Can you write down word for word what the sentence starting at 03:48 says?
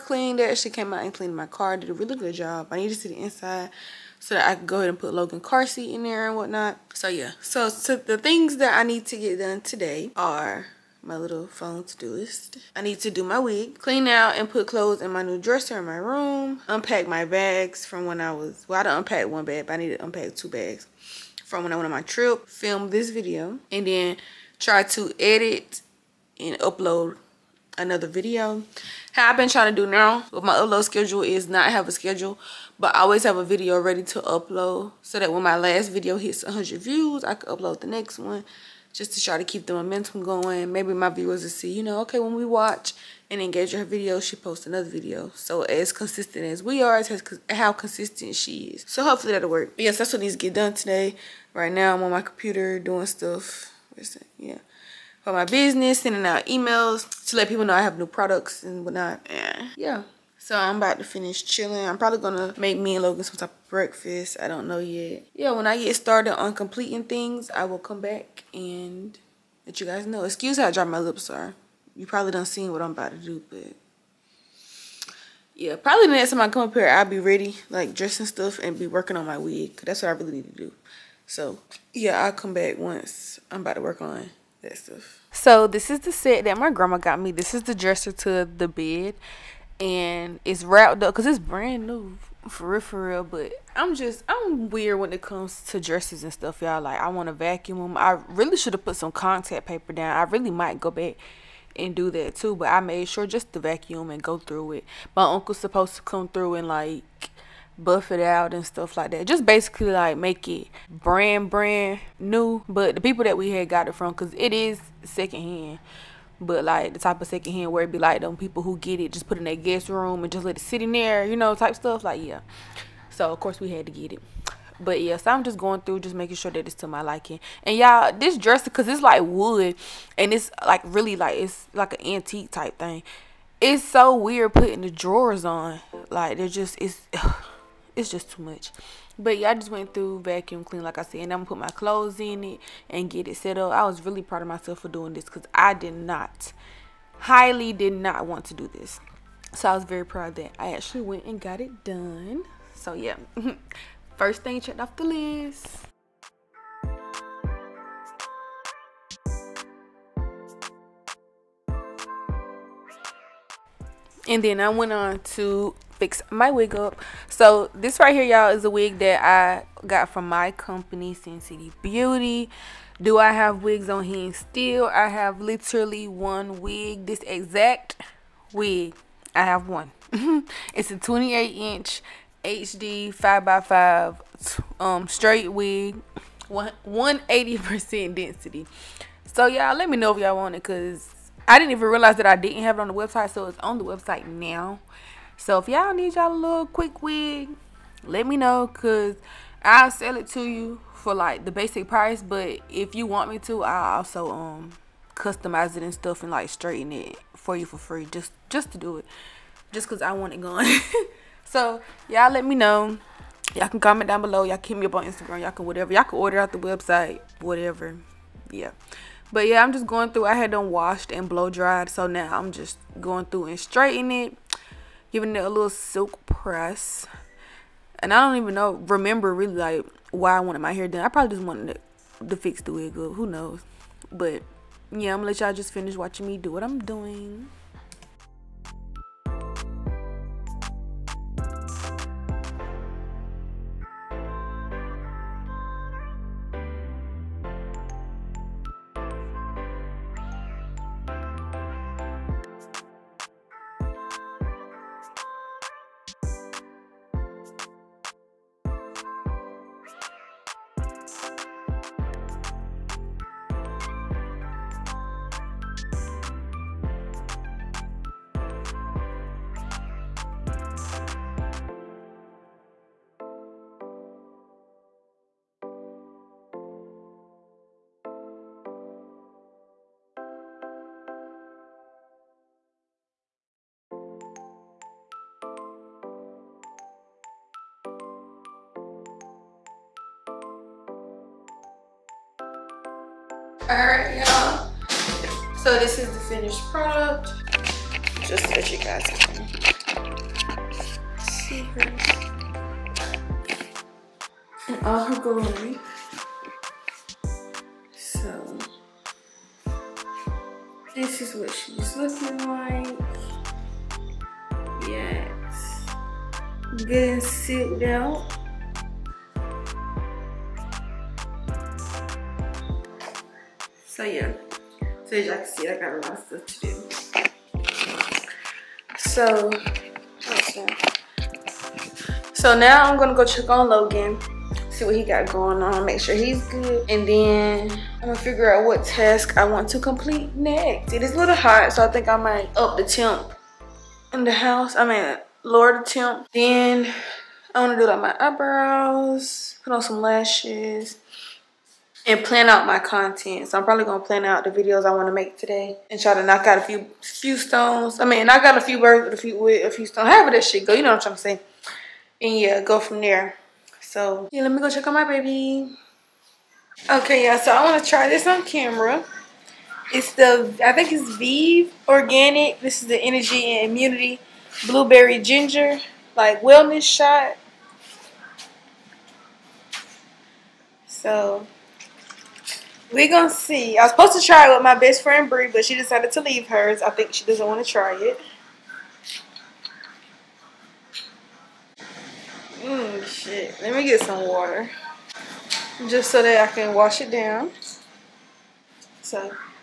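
And I don't even know, remember really like why I wanted my hair done.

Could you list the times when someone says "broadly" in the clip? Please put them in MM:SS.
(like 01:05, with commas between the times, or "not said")
not said.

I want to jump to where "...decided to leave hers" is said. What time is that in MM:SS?
06:25.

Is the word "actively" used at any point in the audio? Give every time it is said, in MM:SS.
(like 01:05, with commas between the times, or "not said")
not said.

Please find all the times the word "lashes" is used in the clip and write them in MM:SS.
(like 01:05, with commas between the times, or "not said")
05:50.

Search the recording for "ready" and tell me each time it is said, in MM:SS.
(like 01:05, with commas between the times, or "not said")
00:33, 01:17.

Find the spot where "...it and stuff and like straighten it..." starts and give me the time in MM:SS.
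03:25.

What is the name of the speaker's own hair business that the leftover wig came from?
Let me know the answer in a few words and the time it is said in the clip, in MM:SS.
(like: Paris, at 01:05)
Cinn City Beauty, at 02:51.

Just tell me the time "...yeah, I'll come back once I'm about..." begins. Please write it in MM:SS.
01:21.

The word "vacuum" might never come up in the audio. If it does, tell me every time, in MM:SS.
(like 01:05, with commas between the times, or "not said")
01:37, 01:43, 02:20.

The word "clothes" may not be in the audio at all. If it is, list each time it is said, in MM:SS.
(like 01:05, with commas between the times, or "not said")
00:14, 02:21.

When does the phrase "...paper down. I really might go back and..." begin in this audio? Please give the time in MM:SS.
01:39.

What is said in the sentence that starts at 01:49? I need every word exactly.
Just basically like make it brand brand new.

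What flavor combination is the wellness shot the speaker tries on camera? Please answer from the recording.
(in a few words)
Blueberry Ginger.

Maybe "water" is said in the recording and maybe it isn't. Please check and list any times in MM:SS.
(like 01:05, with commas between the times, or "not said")
06:34.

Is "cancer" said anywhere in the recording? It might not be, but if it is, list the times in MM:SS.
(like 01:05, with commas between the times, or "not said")
not said.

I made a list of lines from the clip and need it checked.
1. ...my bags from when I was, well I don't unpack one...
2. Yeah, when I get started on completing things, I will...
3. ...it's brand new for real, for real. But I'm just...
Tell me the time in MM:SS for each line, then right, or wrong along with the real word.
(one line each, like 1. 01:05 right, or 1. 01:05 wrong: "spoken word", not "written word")
1. 00:17 right
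2. 01:05 right
3. 01:31 right.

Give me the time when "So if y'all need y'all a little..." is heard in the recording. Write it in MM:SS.
03:15.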